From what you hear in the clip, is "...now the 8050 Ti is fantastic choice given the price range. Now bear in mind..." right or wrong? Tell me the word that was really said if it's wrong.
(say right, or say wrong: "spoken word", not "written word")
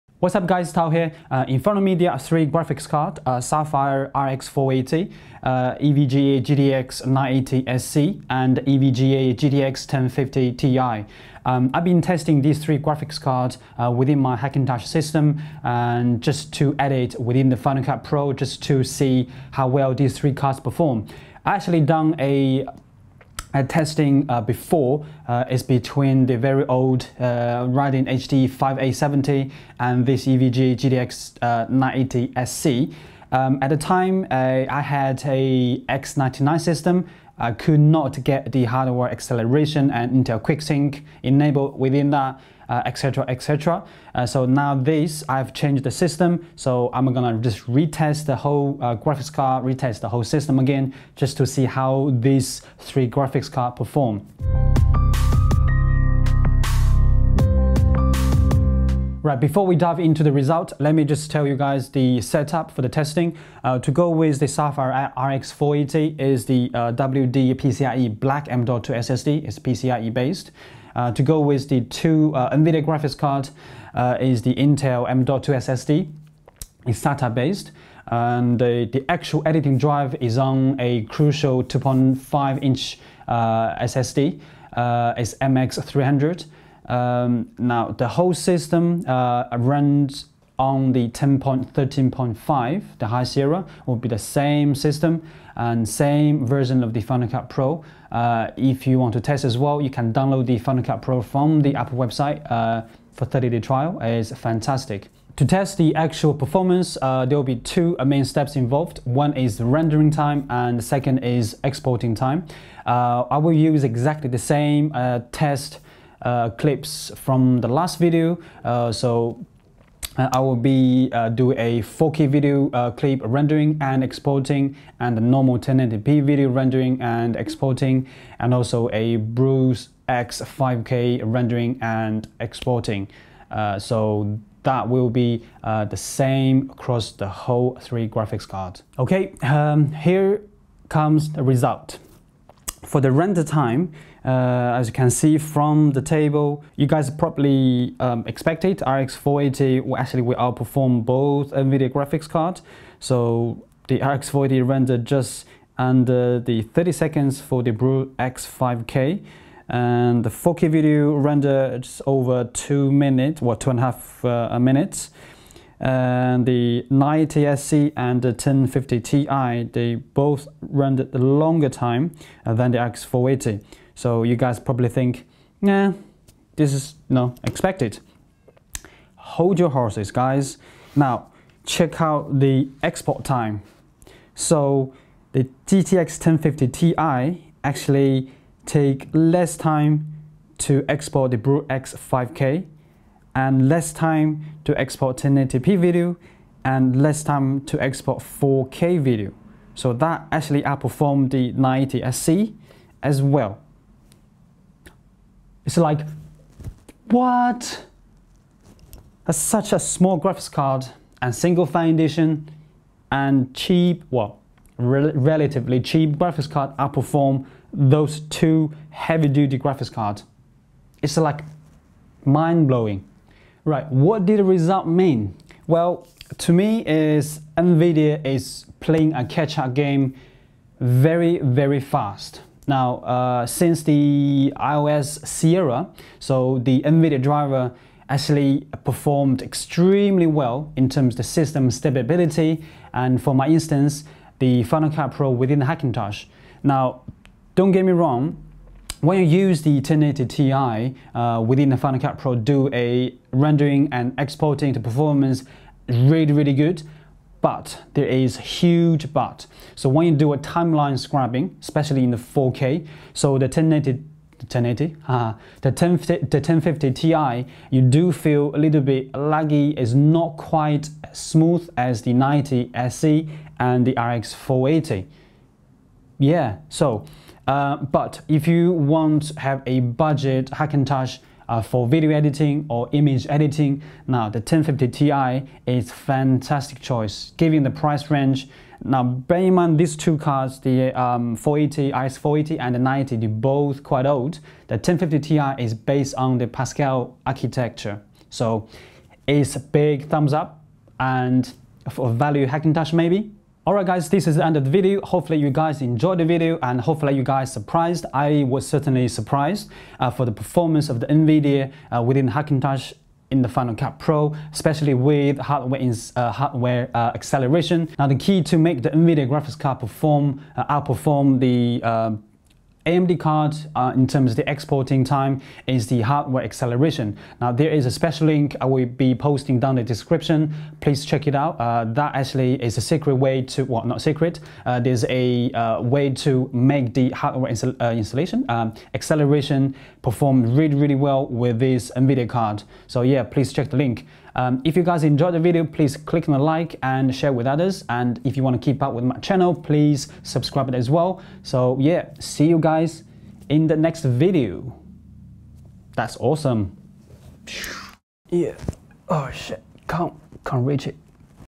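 wrong: "1050", not "8050".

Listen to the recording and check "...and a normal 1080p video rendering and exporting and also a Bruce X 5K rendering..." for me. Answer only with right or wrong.
right.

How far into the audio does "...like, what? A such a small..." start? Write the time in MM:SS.
03:25.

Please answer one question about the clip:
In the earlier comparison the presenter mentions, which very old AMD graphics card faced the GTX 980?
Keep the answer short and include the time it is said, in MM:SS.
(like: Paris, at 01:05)
Radeon HD 5870, at 00:27.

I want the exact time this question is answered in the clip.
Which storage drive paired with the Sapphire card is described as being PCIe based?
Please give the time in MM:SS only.
01:06.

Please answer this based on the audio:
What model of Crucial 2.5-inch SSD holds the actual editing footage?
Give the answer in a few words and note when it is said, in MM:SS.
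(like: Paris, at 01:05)
MX300, at 01:25.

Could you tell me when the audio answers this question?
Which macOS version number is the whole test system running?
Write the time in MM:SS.
01:31.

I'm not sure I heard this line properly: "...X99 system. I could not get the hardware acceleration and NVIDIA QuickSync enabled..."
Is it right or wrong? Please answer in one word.
wrong.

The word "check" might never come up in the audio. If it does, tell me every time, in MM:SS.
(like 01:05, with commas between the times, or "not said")
03:01, 05:31, 05:43.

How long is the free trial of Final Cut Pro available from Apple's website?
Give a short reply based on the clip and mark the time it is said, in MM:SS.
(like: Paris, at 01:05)
30 days, at 01:43.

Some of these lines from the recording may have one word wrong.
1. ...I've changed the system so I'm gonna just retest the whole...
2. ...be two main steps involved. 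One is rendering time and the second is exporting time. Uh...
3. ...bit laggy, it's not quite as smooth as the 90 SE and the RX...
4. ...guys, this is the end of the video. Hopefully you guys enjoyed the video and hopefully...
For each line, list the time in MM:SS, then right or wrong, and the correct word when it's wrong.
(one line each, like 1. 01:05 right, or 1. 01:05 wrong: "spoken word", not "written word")
1. 00:45 right
2. 01:47 right
3. 04:28 right
4. 05:03 right.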